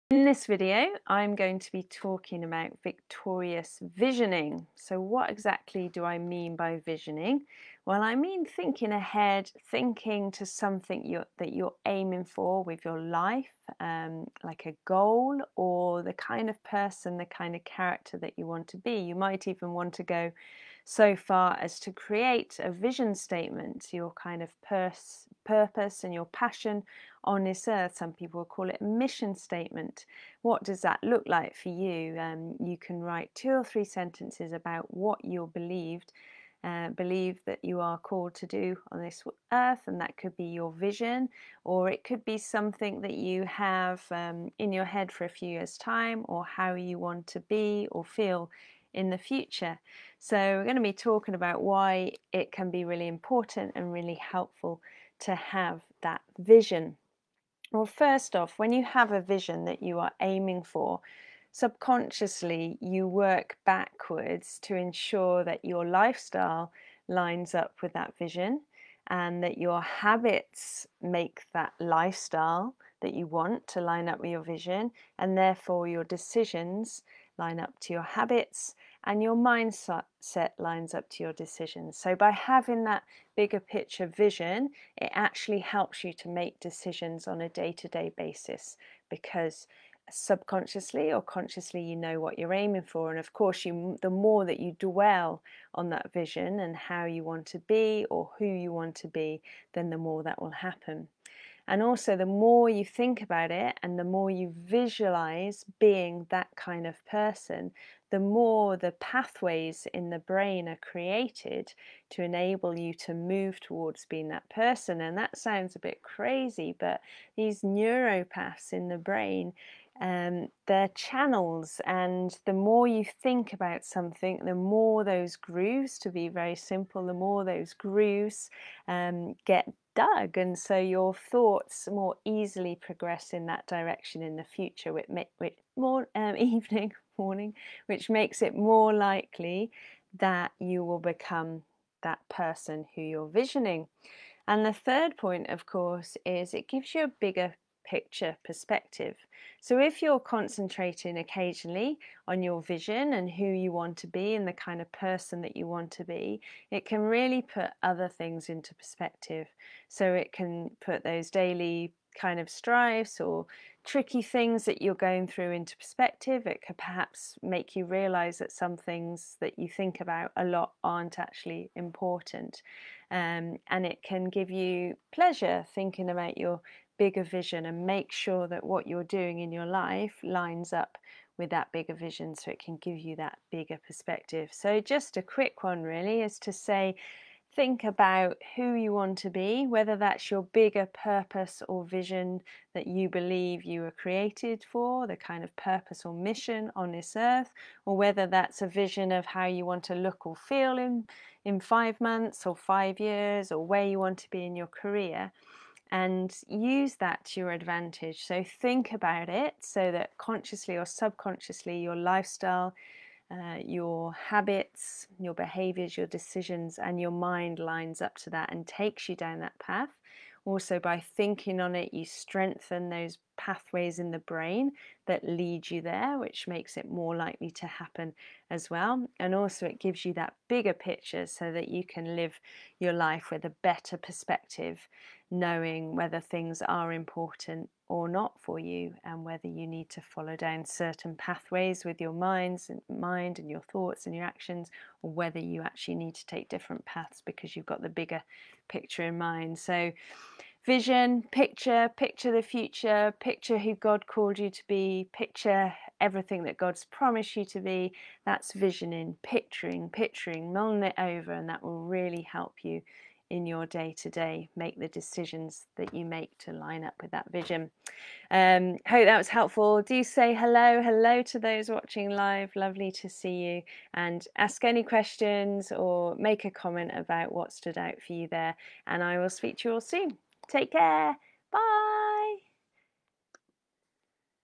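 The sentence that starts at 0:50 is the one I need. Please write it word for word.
So, we're going to be talking about why it can be really important and really helpful to have that vision.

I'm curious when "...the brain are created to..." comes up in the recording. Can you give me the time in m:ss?
1:50.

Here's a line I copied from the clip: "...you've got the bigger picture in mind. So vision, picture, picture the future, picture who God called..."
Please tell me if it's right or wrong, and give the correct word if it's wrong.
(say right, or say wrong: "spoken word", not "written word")
right.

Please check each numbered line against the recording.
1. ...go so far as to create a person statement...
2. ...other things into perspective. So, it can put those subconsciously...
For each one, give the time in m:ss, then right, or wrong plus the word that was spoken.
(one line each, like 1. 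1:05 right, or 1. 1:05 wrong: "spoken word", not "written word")
1. 0:20 wrong: "vision", not "person"
2. 2:37 wrong: "daily", not "subconsciously".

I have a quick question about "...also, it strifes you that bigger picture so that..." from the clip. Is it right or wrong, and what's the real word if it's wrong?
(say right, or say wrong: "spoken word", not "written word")
wrong: "gives", not "strifes".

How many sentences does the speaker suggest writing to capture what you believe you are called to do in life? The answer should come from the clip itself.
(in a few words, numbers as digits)
2 or 3.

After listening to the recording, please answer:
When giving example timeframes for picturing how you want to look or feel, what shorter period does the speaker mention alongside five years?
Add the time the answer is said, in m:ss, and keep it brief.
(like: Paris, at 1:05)
5 months, at 3:21.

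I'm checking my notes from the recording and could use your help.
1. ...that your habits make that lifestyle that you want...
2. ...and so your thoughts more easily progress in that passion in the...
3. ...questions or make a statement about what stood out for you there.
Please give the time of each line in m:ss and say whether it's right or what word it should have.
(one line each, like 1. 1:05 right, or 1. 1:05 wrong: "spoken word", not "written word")
1. 1:09 right
2. 2:10 wrong: "direction", not "passion"
3. 4:34 wrong: "comment", not "statement".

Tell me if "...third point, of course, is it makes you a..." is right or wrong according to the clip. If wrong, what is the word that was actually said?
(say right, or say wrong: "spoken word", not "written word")
wrong: "gives", not "makes".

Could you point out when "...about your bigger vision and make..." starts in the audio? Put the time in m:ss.
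2:56.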